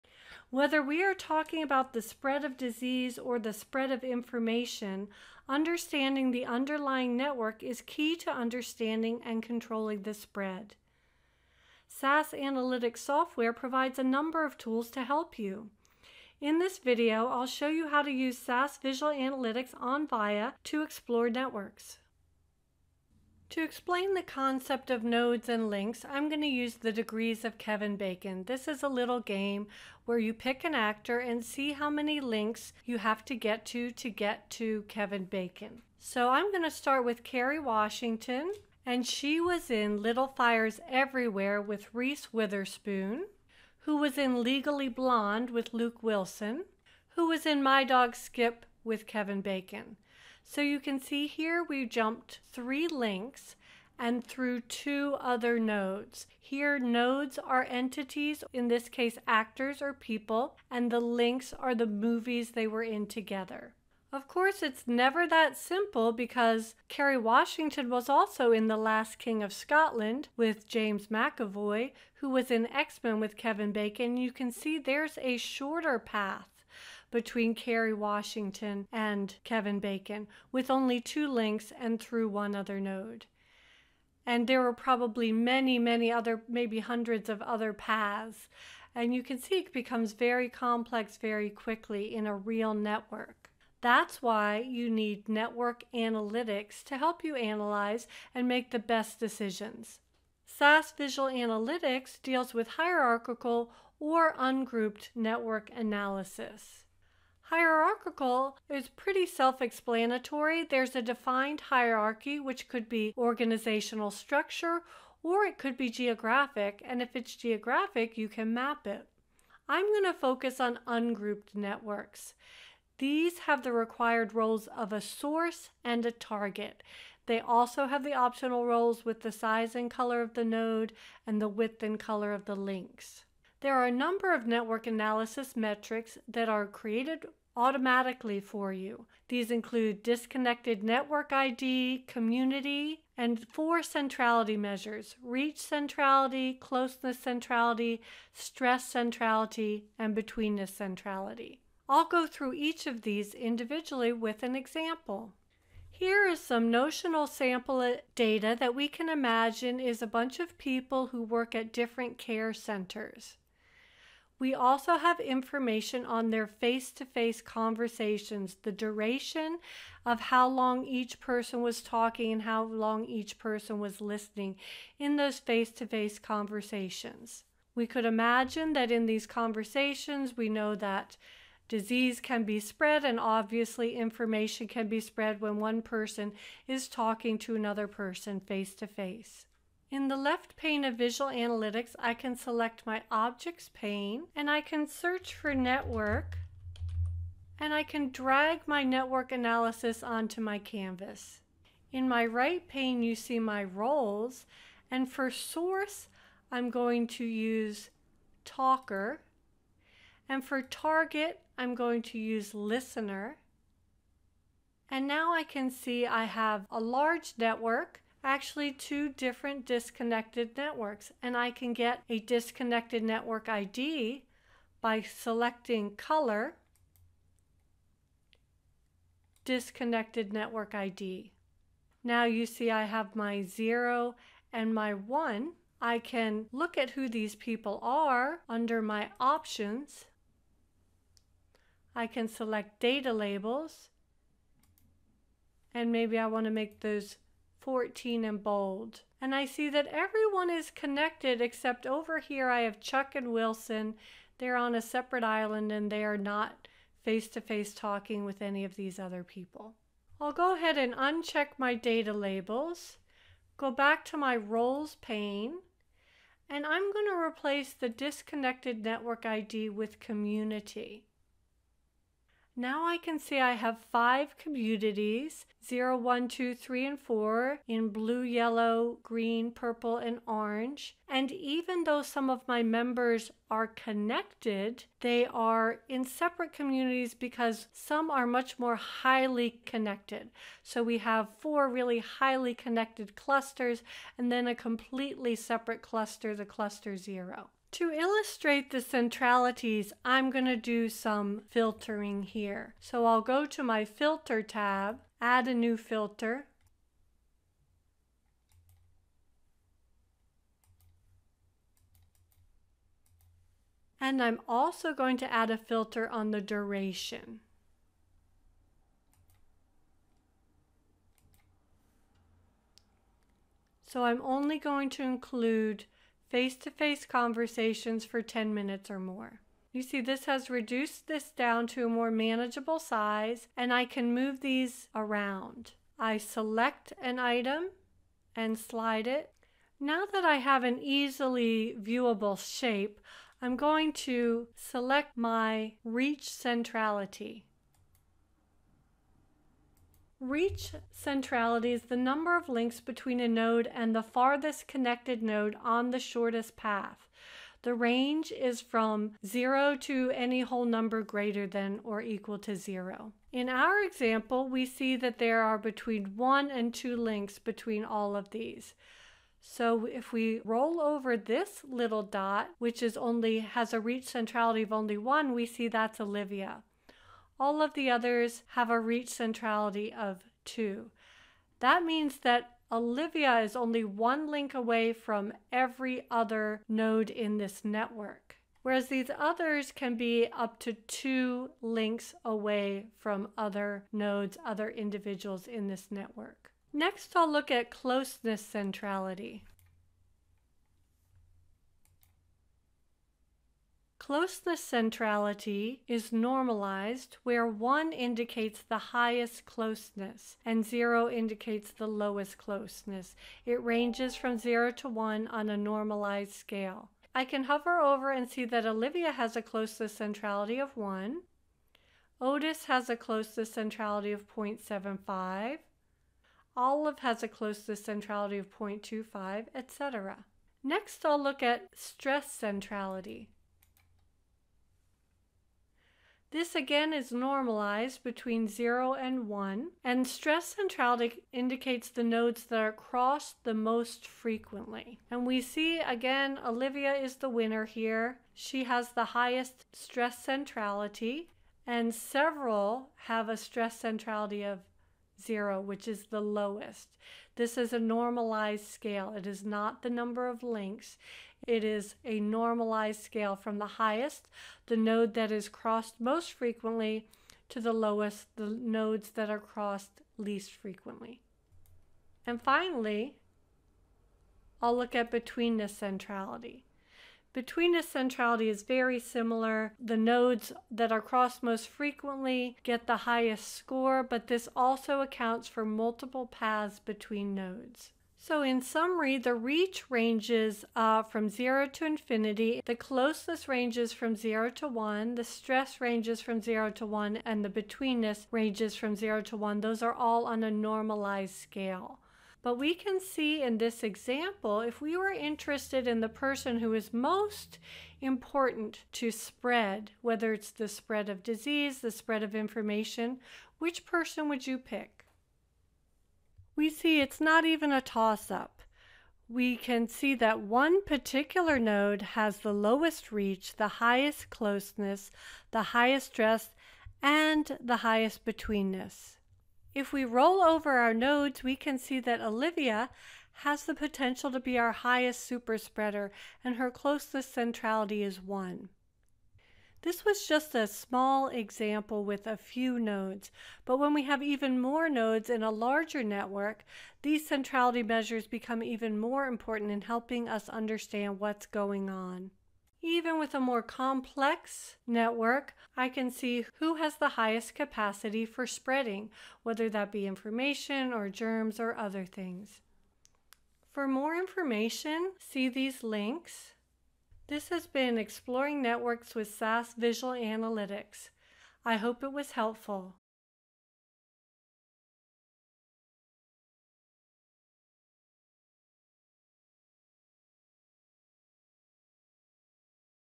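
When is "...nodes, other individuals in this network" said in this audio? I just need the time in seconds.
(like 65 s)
393 s.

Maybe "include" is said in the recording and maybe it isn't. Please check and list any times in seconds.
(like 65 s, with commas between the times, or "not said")
139 s, 325 s.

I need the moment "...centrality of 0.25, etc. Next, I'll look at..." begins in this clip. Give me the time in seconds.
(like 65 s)
427 s.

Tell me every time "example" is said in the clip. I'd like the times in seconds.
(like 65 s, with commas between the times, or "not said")
154 s, 363 s, 503 s, 541 s.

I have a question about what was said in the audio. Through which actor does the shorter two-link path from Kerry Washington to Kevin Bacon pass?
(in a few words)
James McAvoy.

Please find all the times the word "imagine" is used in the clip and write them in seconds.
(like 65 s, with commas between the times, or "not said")
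159 s, 178 s.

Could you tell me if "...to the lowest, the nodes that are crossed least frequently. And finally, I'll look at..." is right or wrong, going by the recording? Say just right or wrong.
right.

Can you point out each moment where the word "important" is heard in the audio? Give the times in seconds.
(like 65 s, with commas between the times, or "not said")
508 s, 549 s.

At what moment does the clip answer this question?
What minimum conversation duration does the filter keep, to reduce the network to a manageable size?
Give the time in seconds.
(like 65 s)
328 s.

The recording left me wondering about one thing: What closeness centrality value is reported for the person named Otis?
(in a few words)
0.75.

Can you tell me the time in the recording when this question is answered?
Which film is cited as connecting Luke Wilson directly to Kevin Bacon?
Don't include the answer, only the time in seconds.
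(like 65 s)
47 s.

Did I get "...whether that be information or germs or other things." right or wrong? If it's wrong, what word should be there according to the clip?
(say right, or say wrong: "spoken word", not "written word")
right.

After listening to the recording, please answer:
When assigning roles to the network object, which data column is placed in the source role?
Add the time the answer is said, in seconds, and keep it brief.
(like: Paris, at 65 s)
talker, at 208 s.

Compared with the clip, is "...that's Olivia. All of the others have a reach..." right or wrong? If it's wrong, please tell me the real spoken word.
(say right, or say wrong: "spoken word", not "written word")
right.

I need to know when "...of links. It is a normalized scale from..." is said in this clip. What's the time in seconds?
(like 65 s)
460 s.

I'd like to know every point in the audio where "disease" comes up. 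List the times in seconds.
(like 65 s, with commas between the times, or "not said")
2 s, 181 s, 511 s.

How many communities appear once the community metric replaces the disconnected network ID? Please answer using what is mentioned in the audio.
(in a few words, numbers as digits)
5.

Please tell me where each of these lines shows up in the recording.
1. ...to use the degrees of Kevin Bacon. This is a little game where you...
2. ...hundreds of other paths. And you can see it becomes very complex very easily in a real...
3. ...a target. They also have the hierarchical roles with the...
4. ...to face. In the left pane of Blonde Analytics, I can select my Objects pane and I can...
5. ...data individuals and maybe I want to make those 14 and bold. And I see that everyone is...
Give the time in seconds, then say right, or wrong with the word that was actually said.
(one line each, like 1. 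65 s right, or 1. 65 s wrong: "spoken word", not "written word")
1. 26 s right
2. 86 s wrong: "quickly", not "easily"
3. 126 s wrong: "optional", not "hierarchical"
4. 188 s wrong: "Visual", not "Blonde"
5. 242 s wrong: "labels", not "individuals".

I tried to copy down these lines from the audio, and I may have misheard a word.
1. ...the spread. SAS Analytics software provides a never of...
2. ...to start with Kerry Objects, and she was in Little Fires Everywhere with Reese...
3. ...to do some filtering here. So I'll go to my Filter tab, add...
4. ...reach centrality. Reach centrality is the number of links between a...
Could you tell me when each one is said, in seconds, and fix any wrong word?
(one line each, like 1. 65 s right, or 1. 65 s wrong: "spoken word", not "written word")
1. 10 s wrong: "number", not "never"
2. 36 s wrong: "Washington", not "Objects"
3. 300 s right
4. 345 s right.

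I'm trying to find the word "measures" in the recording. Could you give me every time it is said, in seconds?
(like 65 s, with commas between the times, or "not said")
144 s, 547 s.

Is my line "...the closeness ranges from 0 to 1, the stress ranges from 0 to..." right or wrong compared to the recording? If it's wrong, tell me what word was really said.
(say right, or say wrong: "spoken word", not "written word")
right.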